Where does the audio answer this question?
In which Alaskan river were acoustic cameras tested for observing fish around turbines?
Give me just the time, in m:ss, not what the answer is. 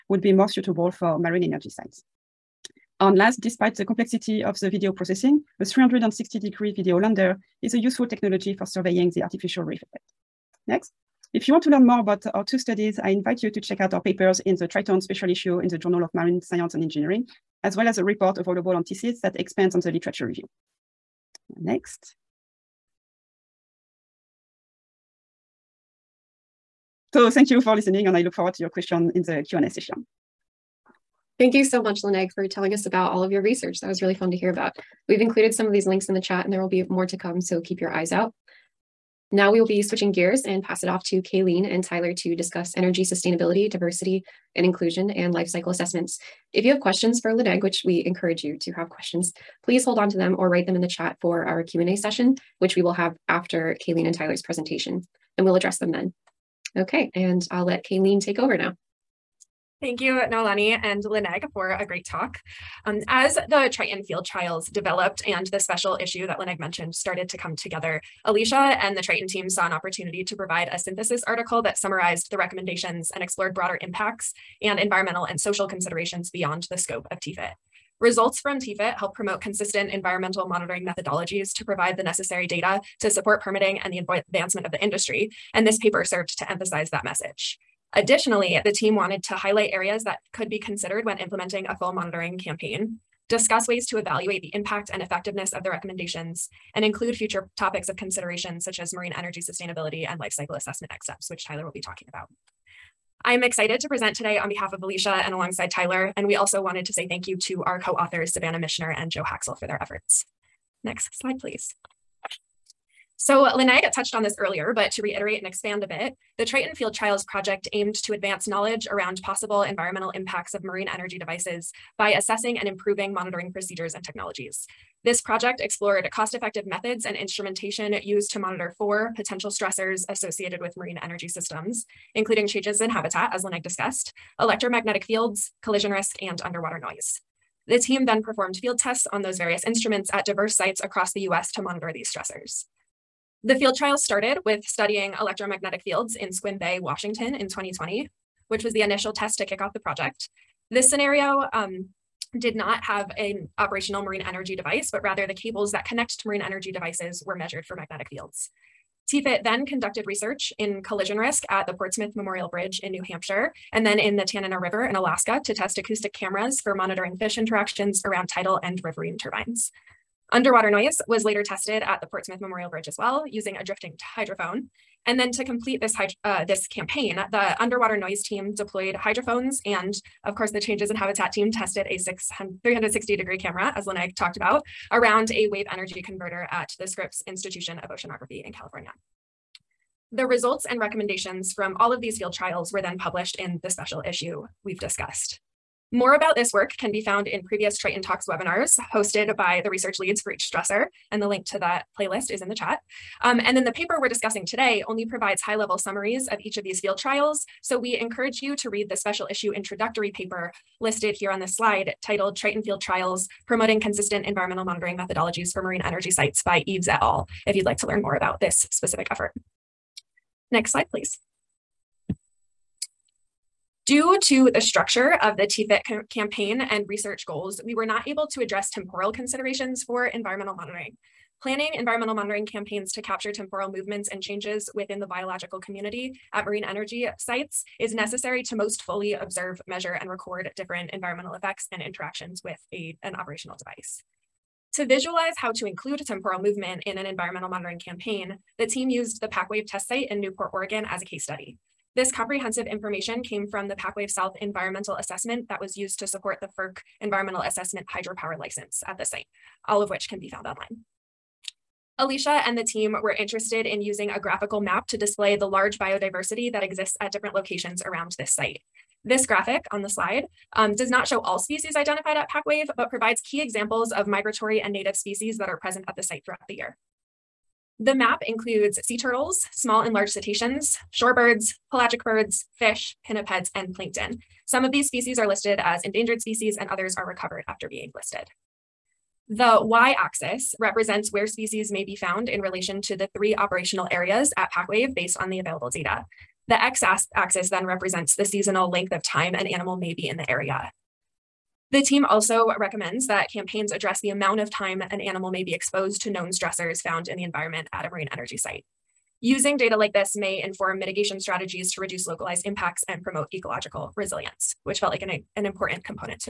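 2:44.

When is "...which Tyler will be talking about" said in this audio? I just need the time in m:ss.
1:41.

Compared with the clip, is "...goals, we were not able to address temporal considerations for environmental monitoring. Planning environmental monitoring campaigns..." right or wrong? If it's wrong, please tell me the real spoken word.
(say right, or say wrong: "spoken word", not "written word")
right.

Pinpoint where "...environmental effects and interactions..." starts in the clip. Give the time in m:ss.
4:00.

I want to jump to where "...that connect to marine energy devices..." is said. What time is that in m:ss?
2:35.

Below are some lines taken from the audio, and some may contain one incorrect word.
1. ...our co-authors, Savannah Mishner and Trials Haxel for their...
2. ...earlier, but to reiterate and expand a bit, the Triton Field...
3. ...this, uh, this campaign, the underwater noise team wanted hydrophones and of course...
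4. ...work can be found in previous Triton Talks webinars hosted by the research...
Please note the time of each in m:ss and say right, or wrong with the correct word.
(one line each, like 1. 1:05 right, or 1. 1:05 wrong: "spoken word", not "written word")
1. 1:47 wrong: "Joe", not "Trials"
2. 1:54 right
3. 2:55 wrong: "deployed", not "wanted"
4. 3:16 right.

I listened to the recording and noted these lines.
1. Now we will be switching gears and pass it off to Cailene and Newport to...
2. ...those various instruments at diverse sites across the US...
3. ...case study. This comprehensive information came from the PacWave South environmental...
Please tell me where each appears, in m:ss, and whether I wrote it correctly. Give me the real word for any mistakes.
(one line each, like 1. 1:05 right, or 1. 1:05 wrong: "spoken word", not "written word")
1. 0:39 wrong: "Tyler", not "Newport"
2. 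2:19 right
3. 4:11 right.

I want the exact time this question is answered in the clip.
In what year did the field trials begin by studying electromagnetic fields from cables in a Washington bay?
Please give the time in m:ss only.
2:27.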